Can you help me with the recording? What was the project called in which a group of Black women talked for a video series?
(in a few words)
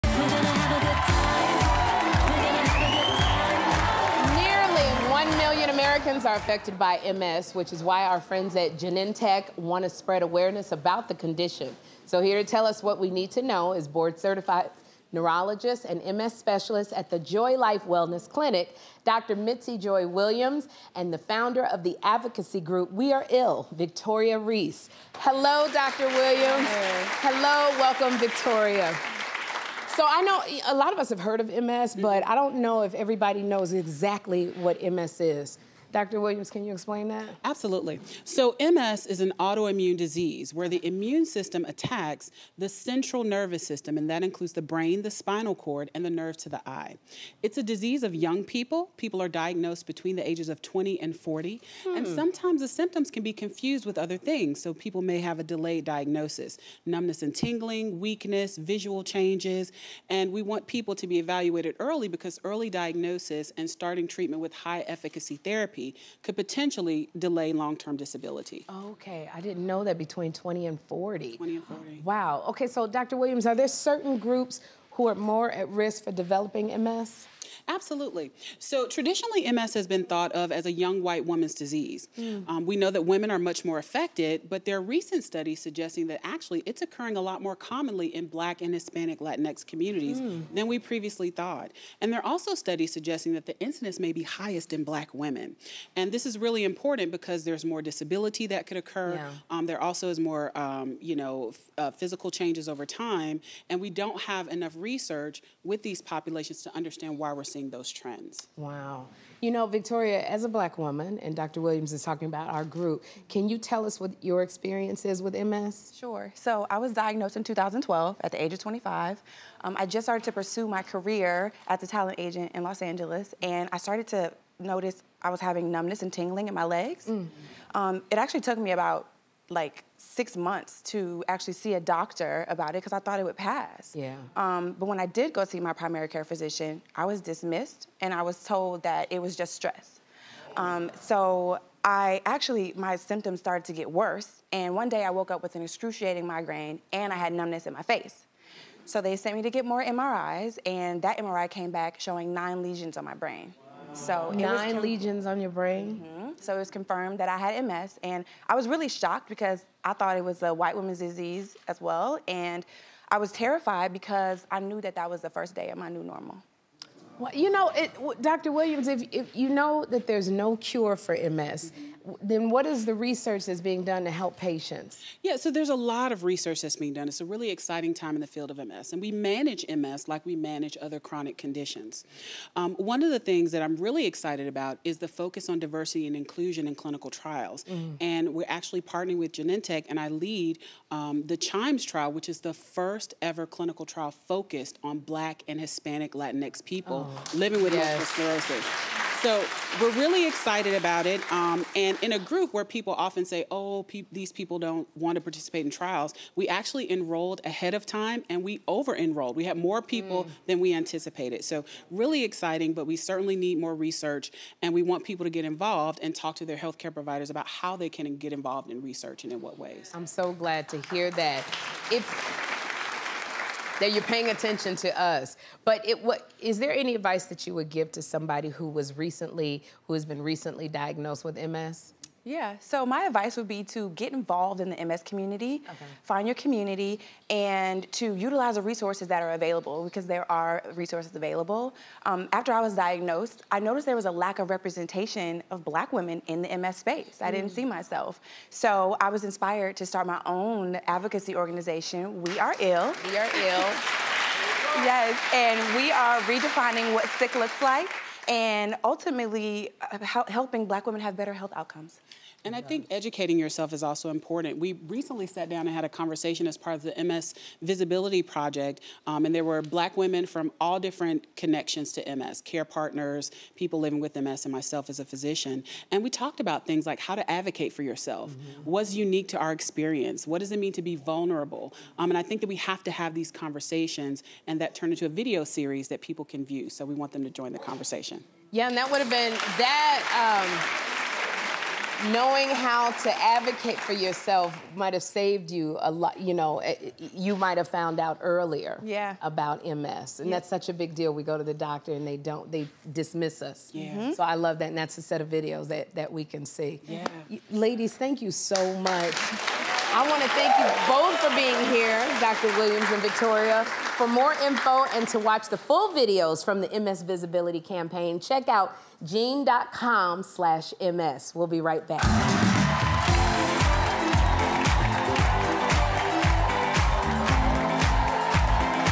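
MS Visibility Project.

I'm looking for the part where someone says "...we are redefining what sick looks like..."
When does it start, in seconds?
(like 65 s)
255 s.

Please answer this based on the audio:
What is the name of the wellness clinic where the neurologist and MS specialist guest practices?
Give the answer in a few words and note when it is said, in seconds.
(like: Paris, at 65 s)
Joi Life Wellness Clinic, at 17 s.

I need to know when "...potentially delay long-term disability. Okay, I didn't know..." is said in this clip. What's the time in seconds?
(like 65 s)
66 s.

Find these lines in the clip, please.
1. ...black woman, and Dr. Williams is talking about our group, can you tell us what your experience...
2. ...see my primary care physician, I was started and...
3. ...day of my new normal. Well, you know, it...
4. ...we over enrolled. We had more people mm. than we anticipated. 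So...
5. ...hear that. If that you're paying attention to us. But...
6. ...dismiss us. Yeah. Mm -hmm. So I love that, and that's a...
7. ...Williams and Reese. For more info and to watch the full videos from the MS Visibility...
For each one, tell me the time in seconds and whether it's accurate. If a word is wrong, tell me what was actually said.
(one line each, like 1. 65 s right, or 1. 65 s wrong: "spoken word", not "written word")
1. 110 s right
2. 135 s wrong: "dismissed", not "started"
3. 165 s right
4. 208 s right
5. 220 s right
6. 302 s right
7. 312 s wrong: "Victoria", not "Reese".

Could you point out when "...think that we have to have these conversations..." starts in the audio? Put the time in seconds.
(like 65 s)
282 s.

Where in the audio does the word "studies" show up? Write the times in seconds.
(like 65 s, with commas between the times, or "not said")
85 s, 92 s.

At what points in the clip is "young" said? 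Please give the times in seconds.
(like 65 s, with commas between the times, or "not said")
48 s, 80 s.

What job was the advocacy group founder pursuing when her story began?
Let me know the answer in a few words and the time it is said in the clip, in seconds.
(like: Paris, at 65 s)
Talent agent, at 121 s.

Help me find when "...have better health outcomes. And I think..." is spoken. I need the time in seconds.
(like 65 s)
261 s.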